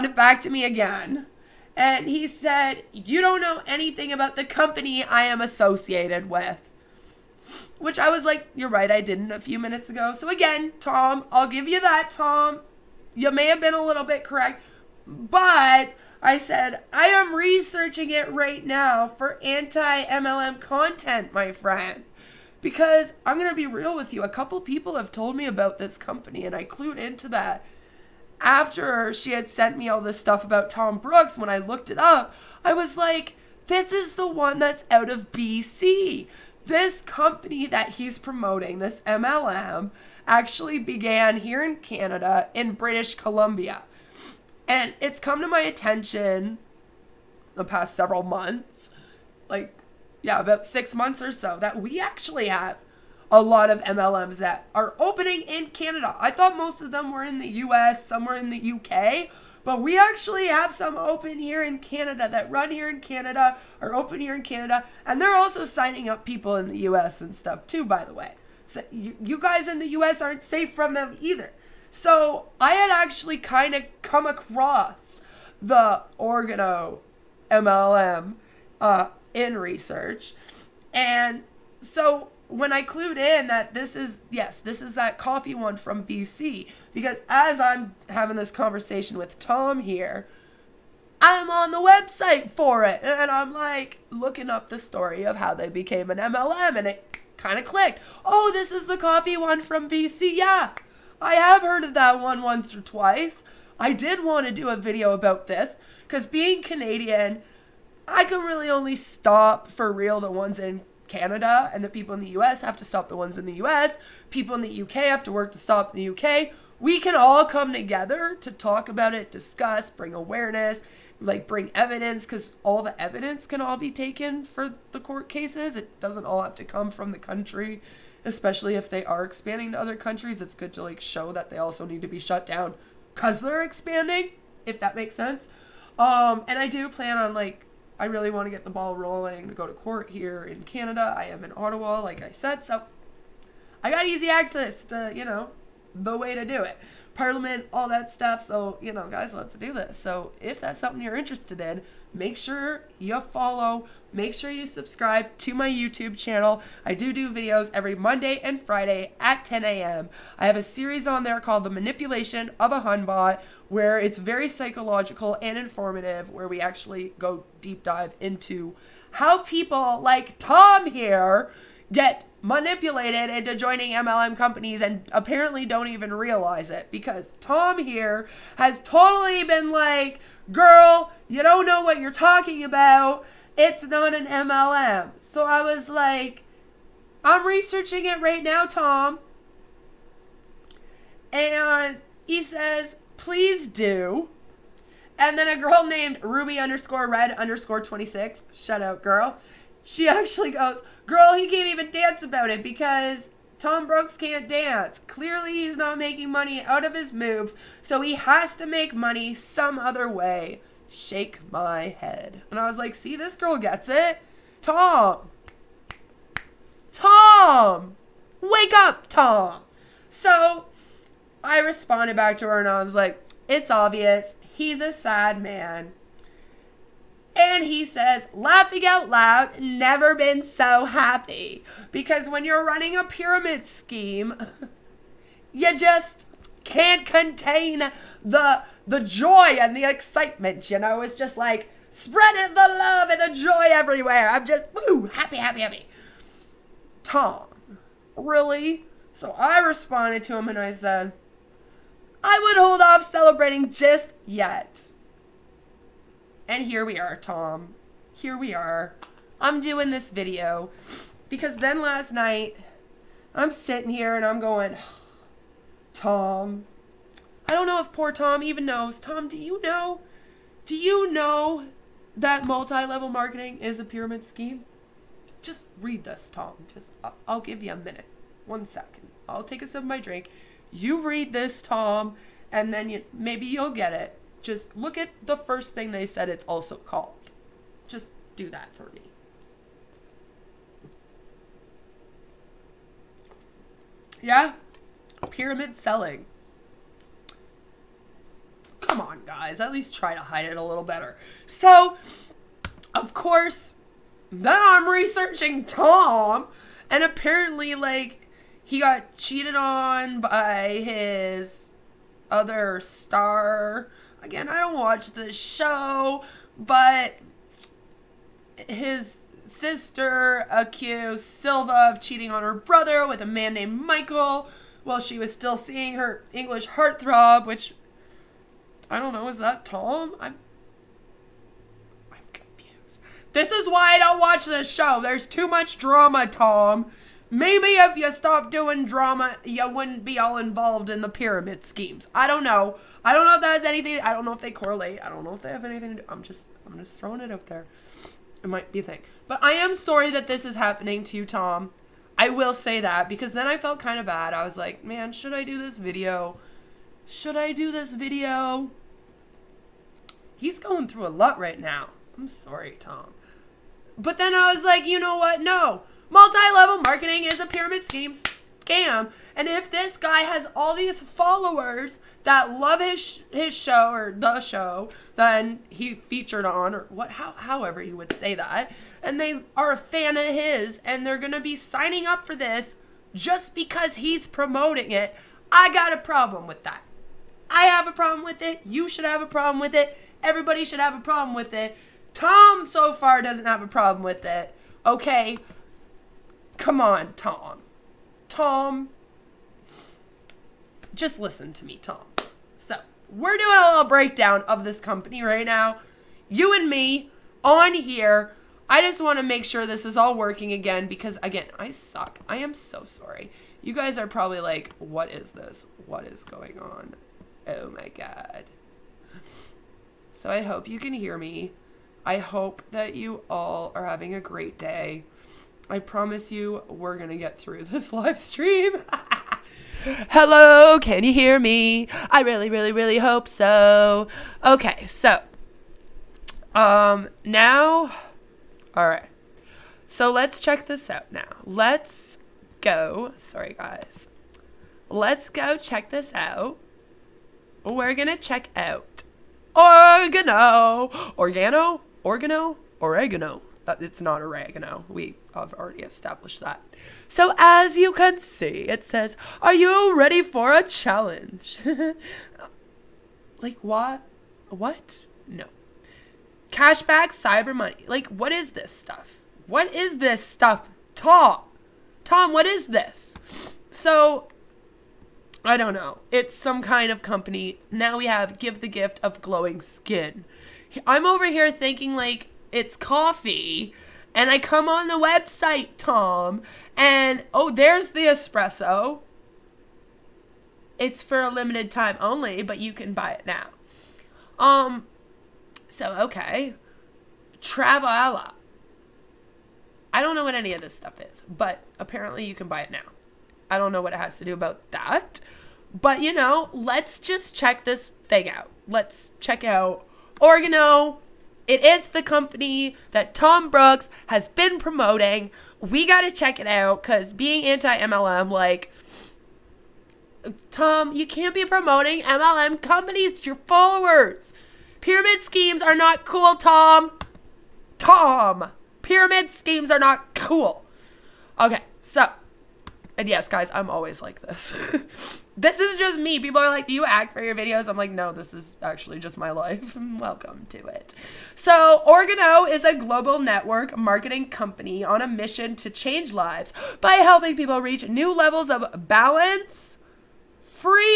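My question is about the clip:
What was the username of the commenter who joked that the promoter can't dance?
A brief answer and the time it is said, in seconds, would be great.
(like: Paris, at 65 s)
Ruby_red_26, at 196 s.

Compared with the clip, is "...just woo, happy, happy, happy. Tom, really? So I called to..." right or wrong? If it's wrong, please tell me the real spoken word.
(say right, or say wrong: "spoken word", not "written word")
wrong: "responded", not "called".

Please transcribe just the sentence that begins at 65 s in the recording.
And they're also signing up people in the US and stuff too, by the way.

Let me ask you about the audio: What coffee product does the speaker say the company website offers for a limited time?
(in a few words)
Espresso.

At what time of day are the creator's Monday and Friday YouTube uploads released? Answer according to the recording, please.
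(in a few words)
10 a.m.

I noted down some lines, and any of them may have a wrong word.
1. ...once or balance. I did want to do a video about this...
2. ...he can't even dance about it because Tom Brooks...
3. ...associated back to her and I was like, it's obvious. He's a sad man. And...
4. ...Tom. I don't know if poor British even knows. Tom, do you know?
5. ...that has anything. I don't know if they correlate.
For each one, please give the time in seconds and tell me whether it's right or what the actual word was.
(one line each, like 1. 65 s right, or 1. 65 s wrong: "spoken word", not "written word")
1. 102 s wrong: "twice", not "balance"
2. 201 s right
3. 221 s wrong: "responded", not "associated"
4. 265 s wrong: "Tom", not "British"
5. 343 s right.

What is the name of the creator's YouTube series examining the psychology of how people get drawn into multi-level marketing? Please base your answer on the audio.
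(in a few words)
The Manipulation of a Hunbot.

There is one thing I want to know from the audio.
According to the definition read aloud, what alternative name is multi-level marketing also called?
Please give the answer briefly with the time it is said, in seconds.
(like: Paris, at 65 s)
Pyramid selling, at 295 s.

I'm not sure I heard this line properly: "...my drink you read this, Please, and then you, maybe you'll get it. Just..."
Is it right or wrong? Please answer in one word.
wrong.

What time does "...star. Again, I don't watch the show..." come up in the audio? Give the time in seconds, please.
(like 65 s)
312 s.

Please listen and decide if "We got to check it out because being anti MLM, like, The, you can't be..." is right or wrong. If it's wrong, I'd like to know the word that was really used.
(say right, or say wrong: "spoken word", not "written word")
wrong: "Tom", not "The".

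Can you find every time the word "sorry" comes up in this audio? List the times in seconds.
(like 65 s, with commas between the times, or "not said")
349 s, 362 s, 412 s, 443 s.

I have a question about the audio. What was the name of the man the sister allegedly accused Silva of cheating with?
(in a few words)
Michael.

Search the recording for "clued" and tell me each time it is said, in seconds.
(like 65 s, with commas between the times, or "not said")
26 s, 82 s.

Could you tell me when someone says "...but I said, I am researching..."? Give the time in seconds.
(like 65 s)
15 s.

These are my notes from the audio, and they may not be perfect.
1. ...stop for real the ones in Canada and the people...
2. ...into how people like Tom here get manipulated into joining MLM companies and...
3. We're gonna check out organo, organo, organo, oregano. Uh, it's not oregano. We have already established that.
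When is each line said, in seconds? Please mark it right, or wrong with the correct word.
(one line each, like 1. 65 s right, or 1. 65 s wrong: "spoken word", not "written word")
1. 108 s right
2. 168 s right
3. 447 s right.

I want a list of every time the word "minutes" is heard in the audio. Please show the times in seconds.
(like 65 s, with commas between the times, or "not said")
9 s, 277 s.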